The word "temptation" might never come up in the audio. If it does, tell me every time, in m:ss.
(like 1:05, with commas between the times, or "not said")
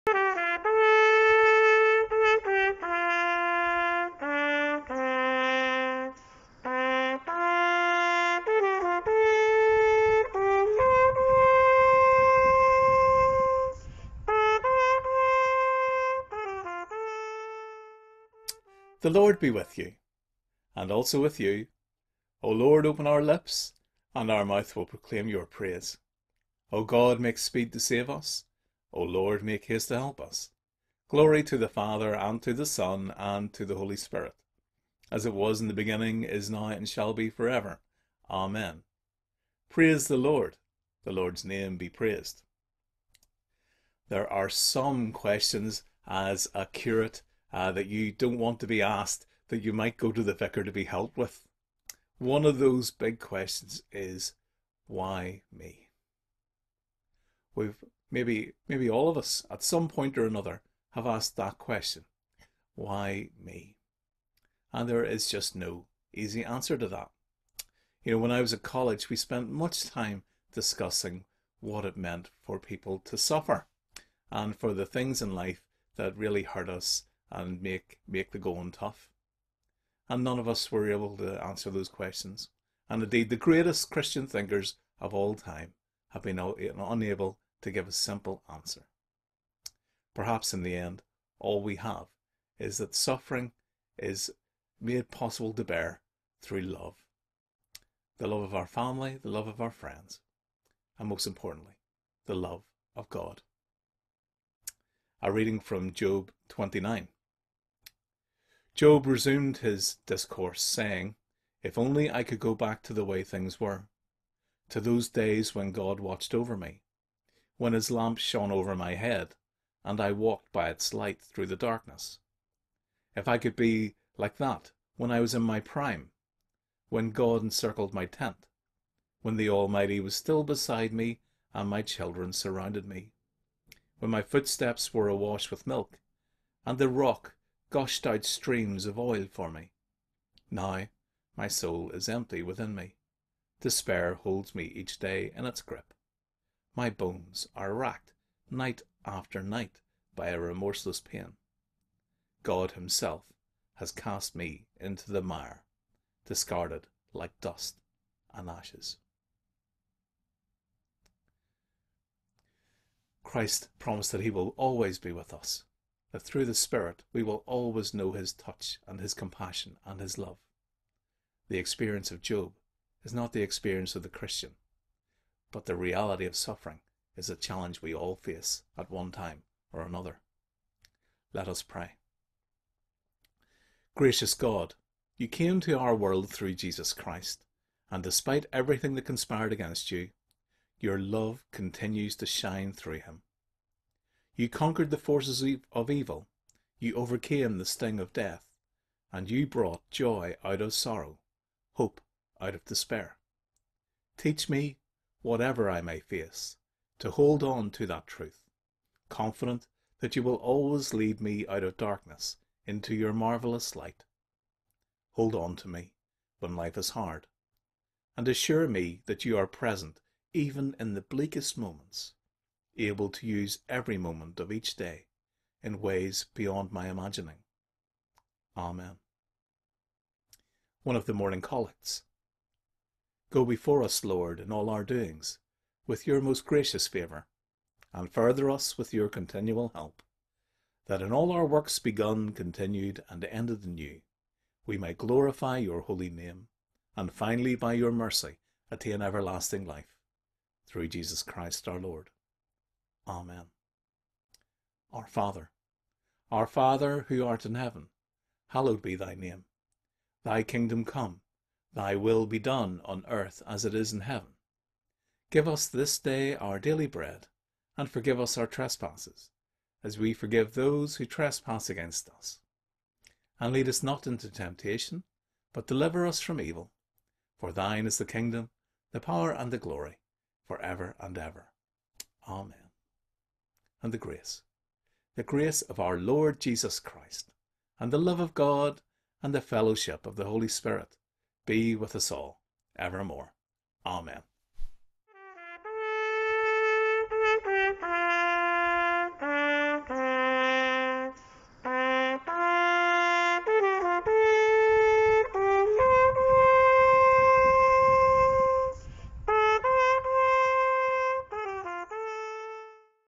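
4:34.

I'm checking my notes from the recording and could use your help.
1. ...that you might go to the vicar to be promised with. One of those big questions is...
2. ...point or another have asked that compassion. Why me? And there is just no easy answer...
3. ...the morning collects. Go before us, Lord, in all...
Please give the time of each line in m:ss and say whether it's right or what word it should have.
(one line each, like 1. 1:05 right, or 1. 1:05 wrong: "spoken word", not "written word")
1. 0:49 wrong: "helped", not "promised"
2. 0:59 wrong: "question", not "compassion"
3. 3:51 right.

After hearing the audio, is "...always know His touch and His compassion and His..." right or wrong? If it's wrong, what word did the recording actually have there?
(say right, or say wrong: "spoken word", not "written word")
right.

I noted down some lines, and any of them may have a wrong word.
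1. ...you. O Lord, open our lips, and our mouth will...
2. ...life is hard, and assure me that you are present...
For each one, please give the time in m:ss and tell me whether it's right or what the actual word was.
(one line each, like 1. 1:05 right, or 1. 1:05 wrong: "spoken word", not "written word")
1. 0:21 right
2. 3:36 right.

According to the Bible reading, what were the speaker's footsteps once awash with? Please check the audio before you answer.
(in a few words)
Milk.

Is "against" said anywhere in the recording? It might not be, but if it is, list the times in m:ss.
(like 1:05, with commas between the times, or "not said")
3:09, 4:31.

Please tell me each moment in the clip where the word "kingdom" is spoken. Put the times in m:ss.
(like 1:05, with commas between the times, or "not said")
4:20, 4:38.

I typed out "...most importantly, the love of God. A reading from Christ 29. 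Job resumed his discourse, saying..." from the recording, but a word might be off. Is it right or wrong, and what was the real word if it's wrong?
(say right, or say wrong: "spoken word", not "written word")
wrong: "Job", not "Christ".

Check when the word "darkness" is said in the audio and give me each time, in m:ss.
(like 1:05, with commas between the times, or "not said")
2:01, 3:31.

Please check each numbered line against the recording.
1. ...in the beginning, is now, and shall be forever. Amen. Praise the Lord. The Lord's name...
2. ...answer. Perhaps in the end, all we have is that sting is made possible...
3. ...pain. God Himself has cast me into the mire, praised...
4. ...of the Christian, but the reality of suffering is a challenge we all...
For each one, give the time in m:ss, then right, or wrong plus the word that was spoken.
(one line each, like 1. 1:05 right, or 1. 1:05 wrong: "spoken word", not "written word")
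1. 0:35 right
2. 1:28 wrong: "suffering", not "sting"
3. 2:30 wrong: "discarded", not "praised"
4. 2:53 right.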